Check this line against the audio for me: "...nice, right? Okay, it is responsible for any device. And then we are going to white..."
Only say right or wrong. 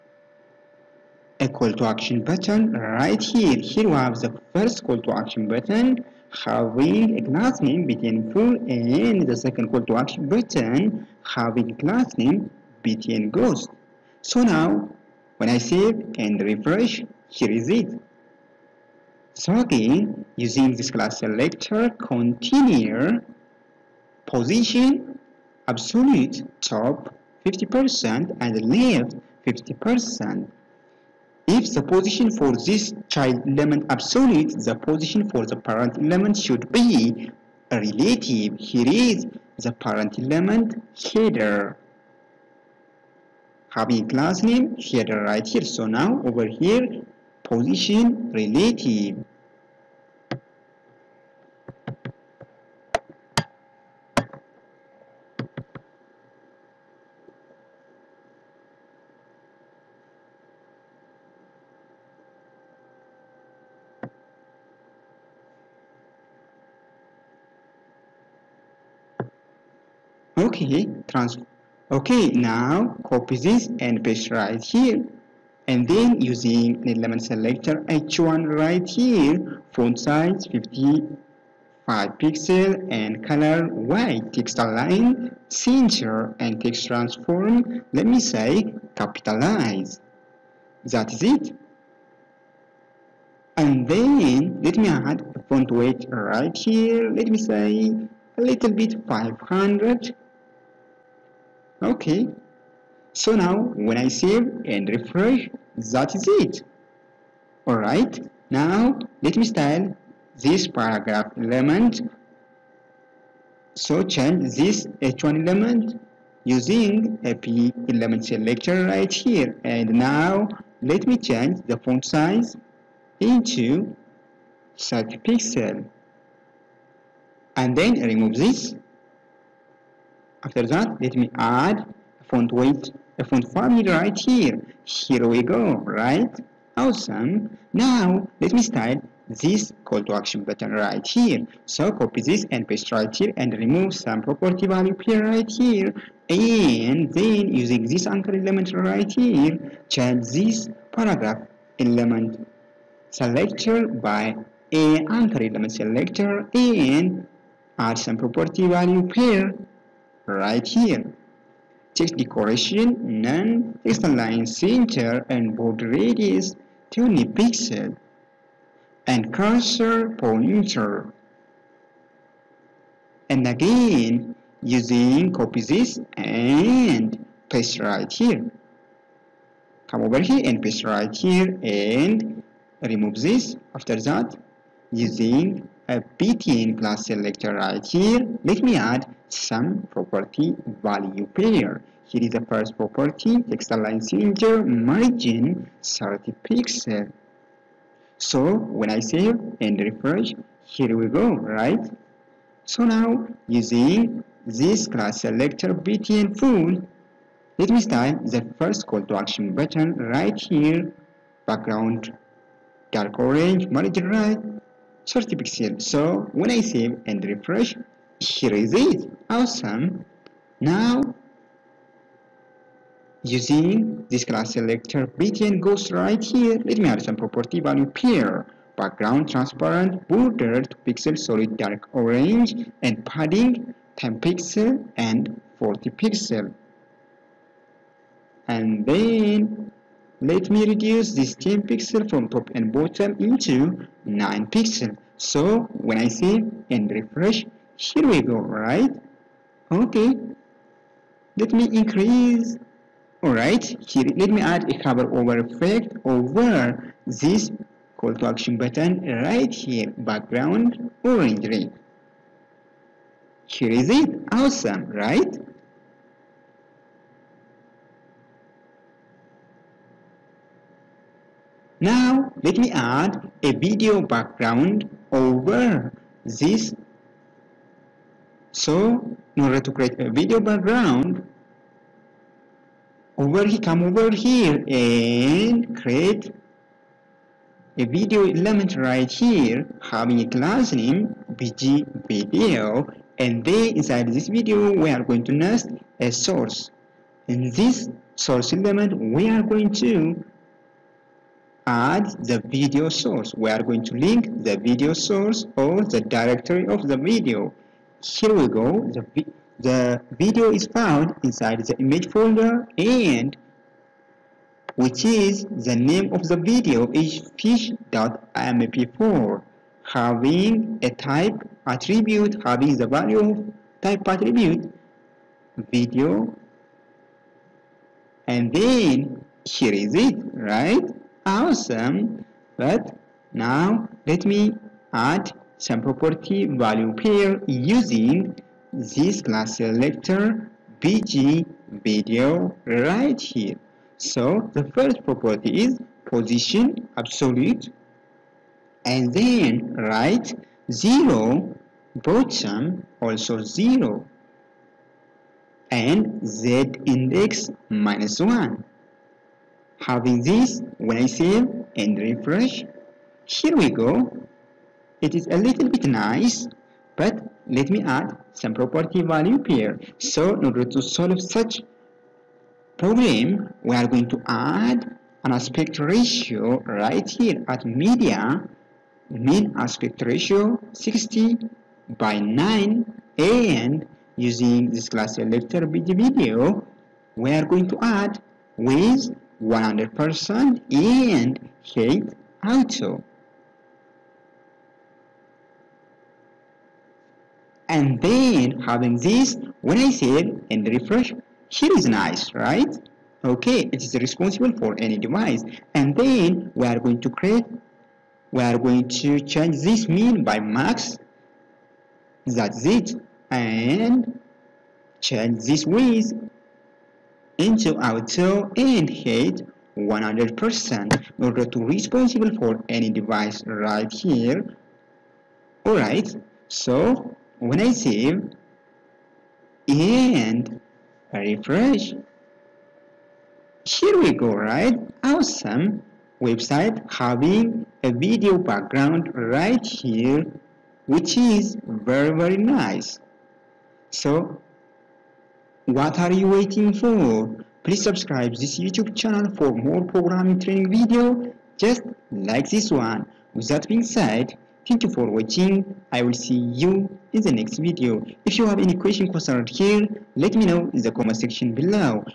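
wrong.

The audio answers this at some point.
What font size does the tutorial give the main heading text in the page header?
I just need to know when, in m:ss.
1:19.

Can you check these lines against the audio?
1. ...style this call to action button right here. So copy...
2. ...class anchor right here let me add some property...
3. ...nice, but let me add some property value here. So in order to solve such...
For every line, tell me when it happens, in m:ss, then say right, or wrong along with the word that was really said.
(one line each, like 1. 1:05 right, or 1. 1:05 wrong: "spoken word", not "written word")
1. 2:18 right
2. 3:06 wrong: "selector", not "anchor"
3. 6:05 right.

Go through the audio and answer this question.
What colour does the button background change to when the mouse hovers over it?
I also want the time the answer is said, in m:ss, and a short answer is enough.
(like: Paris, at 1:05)
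orange red, at 4:19.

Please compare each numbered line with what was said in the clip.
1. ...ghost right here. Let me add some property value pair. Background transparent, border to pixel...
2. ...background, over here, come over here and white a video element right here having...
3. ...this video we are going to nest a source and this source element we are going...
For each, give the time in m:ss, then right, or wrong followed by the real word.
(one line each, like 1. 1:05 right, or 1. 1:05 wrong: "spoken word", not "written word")
1. 3:45 right
2. 4:40 wrong: "create", not "white"
3. 4:54 right.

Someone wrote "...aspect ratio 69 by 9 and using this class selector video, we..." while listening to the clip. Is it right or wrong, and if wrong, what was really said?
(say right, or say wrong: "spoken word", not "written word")
wrong: "60", not "69".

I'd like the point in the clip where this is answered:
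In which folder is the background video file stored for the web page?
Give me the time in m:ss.
5:11.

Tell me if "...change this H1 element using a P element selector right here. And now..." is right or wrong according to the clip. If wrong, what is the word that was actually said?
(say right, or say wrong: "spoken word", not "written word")
right.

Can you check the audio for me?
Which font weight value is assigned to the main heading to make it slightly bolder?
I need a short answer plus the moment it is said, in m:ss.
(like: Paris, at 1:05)
500, at 1:39.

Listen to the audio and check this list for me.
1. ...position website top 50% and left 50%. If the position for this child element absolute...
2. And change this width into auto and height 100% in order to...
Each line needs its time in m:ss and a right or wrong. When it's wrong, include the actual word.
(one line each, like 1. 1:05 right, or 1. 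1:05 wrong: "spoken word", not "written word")
1. 0:24 wrong: "absolute", not "website"
2. 6:53 right.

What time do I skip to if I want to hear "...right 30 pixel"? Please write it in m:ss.
3:34.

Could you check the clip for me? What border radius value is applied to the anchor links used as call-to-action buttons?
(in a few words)
20 pixels.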